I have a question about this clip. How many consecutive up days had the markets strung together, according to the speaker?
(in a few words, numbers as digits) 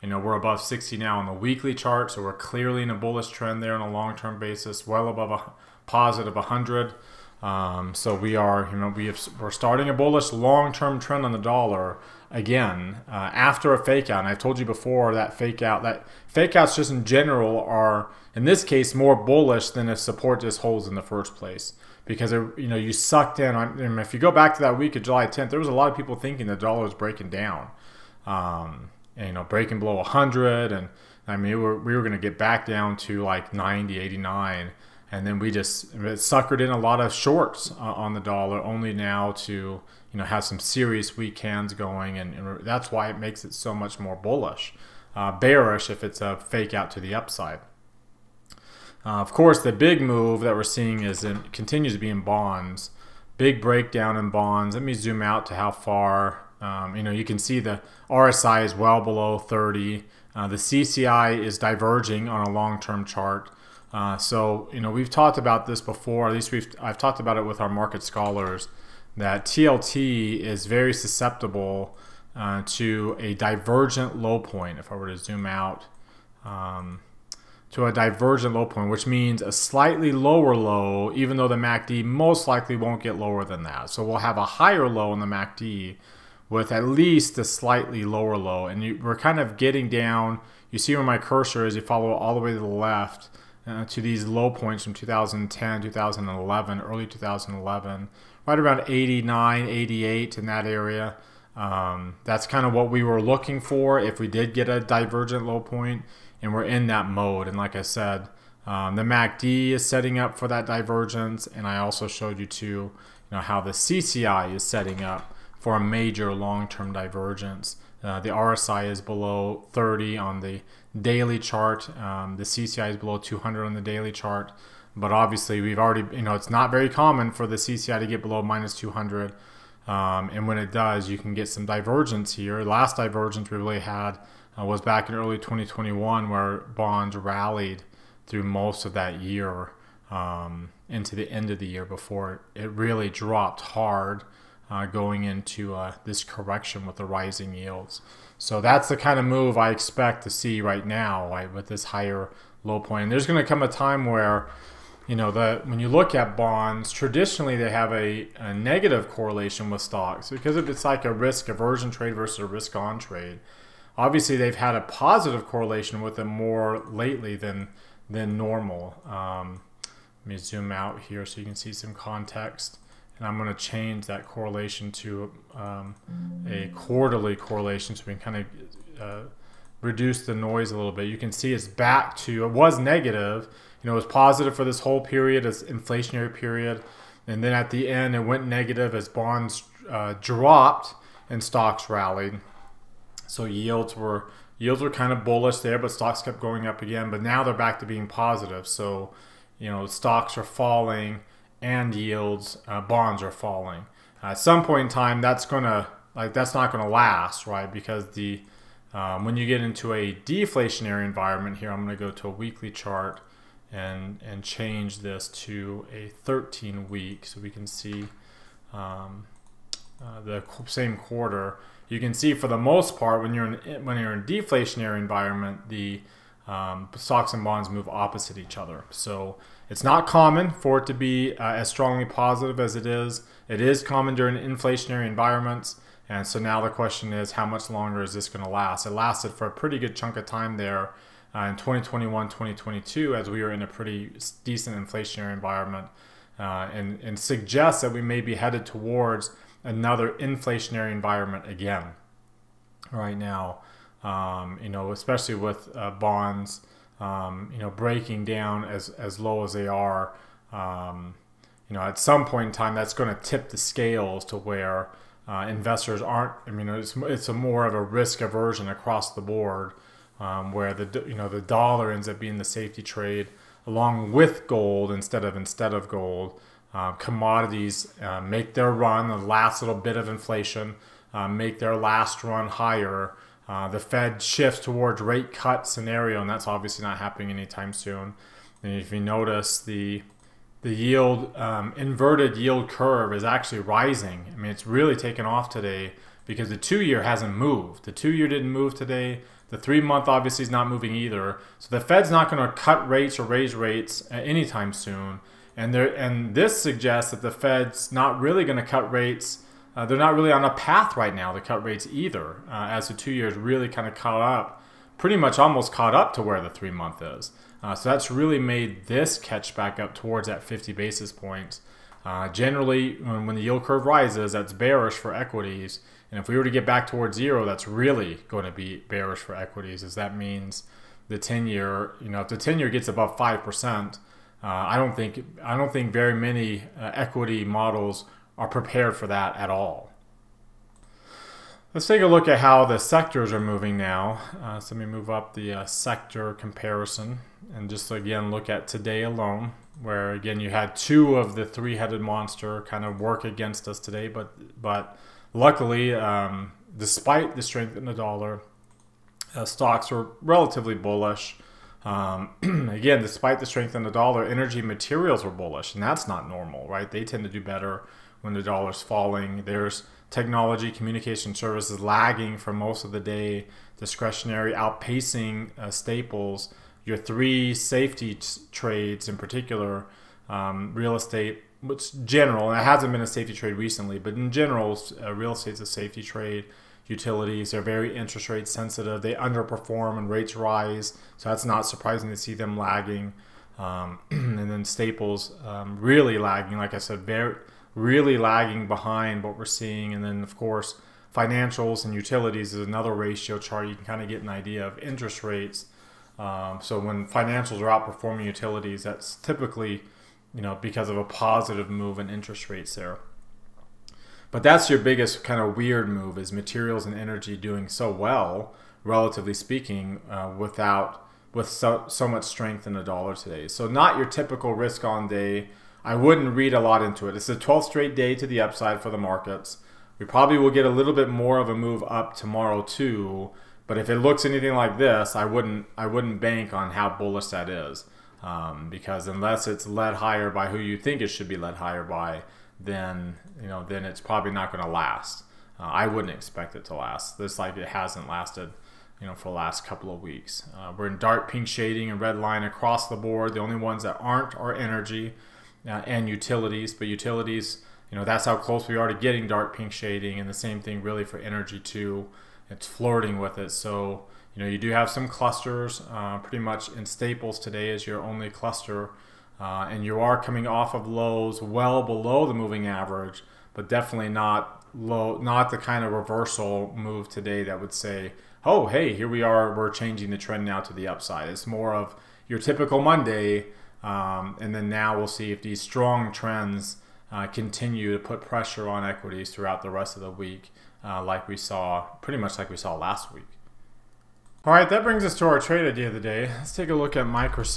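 12.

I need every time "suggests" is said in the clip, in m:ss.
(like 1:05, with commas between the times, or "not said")
4:07, 5:06.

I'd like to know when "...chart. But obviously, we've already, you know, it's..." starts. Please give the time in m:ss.
2:04.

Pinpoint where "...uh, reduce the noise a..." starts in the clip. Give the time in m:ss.
2:59.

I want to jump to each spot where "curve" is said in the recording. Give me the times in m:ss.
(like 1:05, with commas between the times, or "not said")
4:52, 5:23.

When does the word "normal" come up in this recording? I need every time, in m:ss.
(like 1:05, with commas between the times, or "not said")
2:48, 6:06.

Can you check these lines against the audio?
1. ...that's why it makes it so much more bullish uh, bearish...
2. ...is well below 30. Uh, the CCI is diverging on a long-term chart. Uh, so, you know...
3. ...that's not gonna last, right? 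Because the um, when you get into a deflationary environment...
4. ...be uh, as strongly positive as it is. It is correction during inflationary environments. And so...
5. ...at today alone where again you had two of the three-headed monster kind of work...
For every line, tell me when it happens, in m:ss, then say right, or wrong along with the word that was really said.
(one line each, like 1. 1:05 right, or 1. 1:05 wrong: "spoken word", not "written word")
1. 0:42 right
2. 0:58 right
3. 3:26 right
4. 3:50 wrong: "common", not "correction"
5. 5:48 right.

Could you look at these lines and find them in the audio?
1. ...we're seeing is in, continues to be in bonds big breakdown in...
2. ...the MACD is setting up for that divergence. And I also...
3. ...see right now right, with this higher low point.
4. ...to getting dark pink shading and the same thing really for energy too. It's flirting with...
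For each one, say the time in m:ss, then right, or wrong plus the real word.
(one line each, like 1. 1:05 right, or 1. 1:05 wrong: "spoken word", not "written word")
1. 0:50 right
2. 1:48 right
3. 2:30 right
4. 7:38 right.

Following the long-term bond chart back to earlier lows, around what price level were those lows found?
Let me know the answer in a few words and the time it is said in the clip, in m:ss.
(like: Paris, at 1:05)
89, 88, at 1:38.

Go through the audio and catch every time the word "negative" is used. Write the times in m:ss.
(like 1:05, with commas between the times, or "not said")
2:38, 3:02, 3:08.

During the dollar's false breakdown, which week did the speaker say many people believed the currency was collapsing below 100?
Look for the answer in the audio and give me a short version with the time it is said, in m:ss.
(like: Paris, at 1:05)
July 10th, at 0:25.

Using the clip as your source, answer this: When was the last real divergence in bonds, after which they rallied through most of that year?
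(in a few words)
early 2021.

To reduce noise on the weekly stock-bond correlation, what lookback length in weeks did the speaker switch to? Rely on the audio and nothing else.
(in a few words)
13 weeks.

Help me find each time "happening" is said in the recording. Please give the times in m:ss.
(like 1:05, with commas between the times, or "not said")
4:46.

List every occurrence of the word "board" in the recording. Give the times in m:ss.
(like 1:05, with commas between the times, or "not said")
4:29, 7:32.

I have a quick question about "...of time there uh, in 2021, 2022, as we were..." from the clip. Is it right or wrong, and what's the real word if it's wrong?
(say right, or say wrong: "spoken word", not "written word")
right.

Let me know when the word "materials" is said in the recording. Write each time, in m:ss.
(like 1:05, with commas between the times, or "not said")
6:04, 6:56.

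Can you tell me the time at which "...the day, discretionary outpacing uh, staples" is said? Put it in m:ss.
6:12.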